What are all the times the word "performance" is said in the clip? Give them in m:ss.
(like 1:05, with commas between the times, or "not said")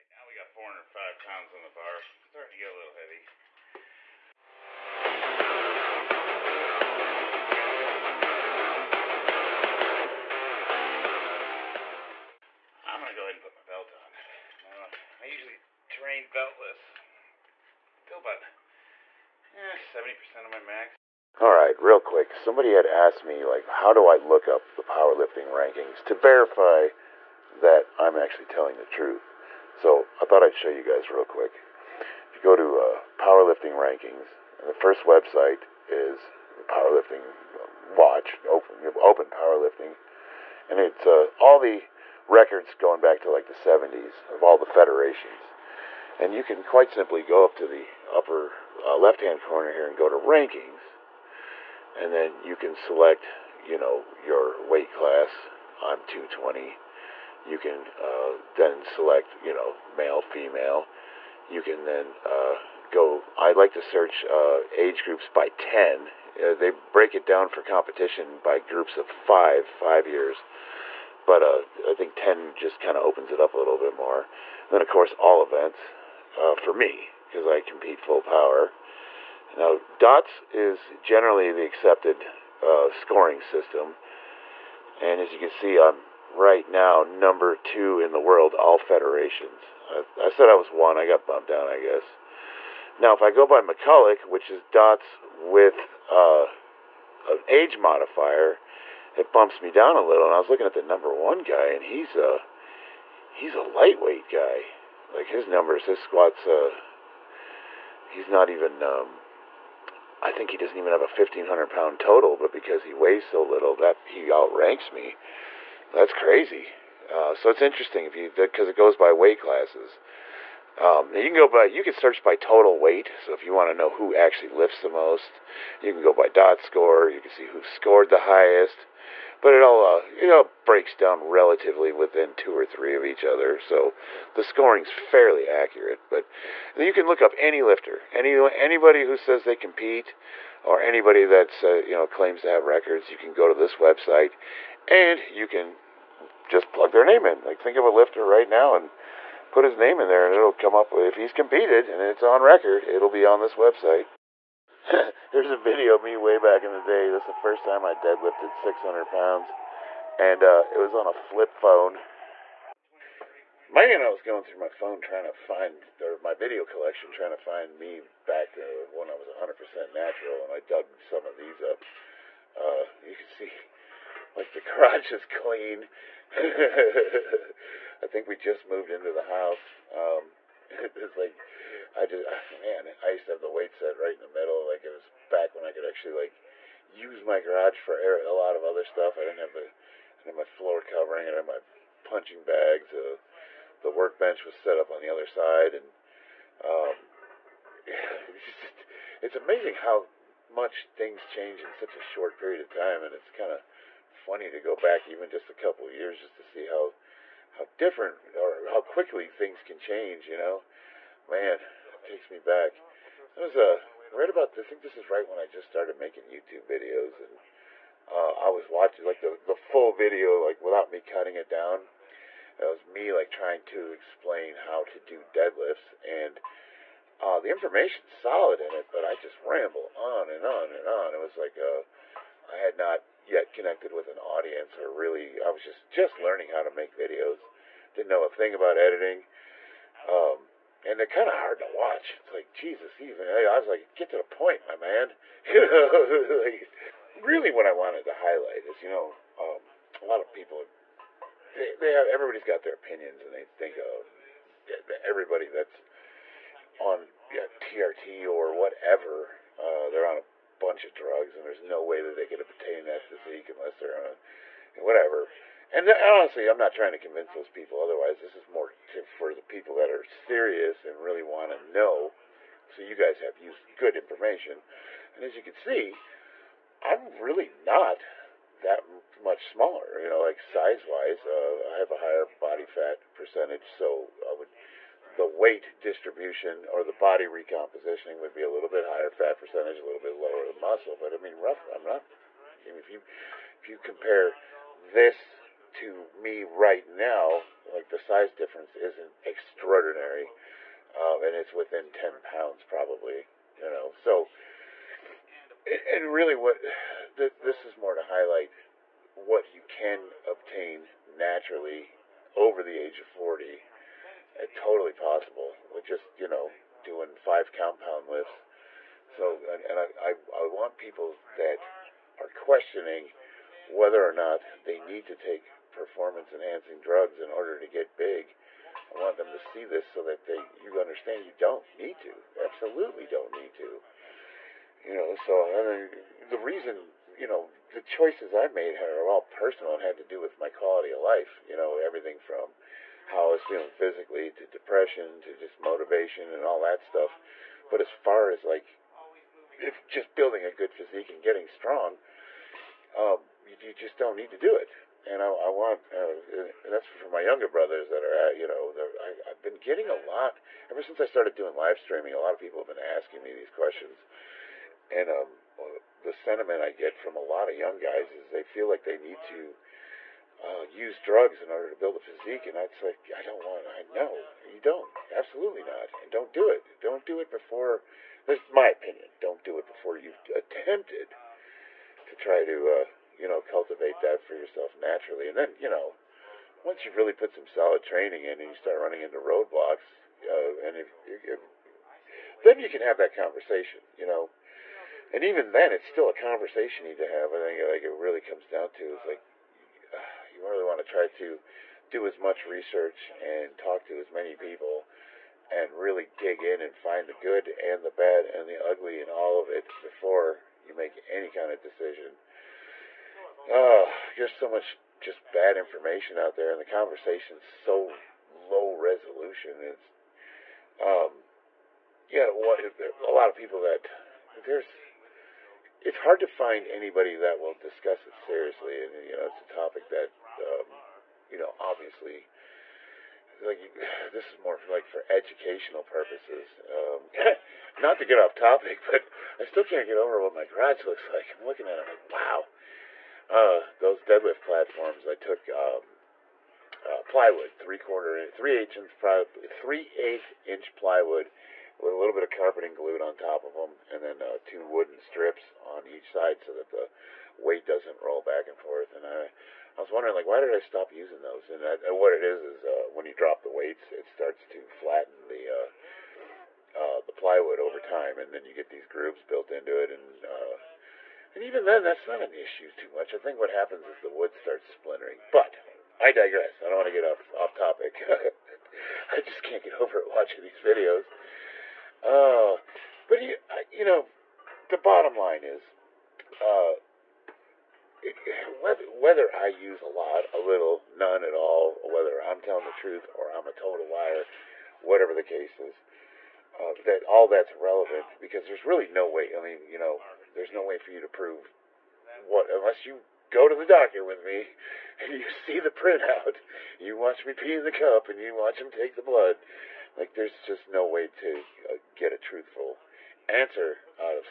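5:25.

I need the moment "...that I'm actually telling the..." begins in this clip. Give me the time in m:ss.
0:27.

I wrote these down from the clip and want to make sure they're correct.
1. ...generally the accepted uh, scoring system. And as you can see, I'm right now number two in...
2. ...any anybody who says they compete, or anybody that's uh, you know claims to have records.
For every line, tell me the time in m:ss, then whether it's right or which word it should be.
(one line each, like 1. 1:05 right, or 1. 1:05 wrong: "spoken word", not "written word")
1. 1:21 right
2. 2:18 right.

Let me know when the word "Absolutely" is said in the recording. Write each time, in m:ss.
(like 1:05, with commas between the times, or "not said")
5:32, 6:15.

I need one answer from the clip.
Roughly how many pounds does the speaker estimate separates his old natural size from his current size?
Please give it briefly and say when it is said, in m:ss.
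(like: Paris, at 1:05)
10 pounds, at 5:01.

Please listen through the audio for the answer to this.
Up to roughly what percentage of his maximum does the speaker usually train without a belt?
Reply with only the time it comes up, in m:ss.
0:19.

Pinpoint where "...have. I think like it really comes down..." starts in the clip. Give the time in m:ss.
6:37.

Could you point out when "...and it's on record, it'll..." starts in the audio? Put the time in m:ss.
2:31.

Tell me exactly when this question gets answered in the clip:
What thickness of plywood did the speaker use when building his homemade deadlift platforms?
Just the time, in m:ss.
7:29.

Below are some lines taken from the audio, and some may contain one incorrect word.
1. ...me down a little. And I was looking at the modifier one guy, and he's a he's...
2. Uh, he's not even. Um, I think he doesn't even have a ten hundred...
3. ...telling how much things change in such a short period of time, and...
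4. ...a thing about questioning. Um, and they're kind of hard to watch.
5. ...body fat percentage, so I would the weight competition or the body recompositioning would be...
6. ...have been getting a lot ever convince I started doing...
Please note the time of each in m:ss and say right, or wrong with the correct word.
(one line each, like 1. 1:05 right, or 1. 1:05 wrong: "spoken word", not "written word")
1. 1:39 wrong: "number", not "modifier"
2. 1:46 wrong: "fifteen", not "ten"
3. 3:19 wrong: "amazing", not "telling"
4. 3:58 wrong: "editing", not "questioning"
5. 4:42 wrong: "distribution", not "competition"
6. 5:59 wrong: "since", not "convince".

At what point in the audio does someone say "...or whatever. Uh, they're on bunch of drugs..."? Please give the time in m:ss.
4:18.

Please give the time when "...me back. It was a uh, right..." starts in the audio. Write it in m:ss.
3:32.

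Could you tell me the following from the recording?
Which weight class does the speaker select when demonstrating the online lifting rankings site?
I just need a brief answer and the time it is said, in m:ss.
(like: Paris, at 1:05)
220, at 0:56.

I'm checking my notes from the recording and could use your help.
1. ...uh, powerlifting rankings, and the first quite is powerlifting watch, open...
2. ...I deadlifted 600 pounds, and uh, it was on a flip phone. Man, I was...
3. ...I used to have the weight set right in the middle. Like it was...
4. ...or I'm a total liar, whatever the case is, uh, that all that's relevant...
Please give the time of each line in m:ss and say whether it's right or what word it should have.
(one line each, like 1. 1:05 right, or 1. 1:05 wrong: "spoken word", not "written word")
1. 0:32 wrong: "website", not "quite"
2. 2:37 right
3. 3:03 right
4. 8:13 right.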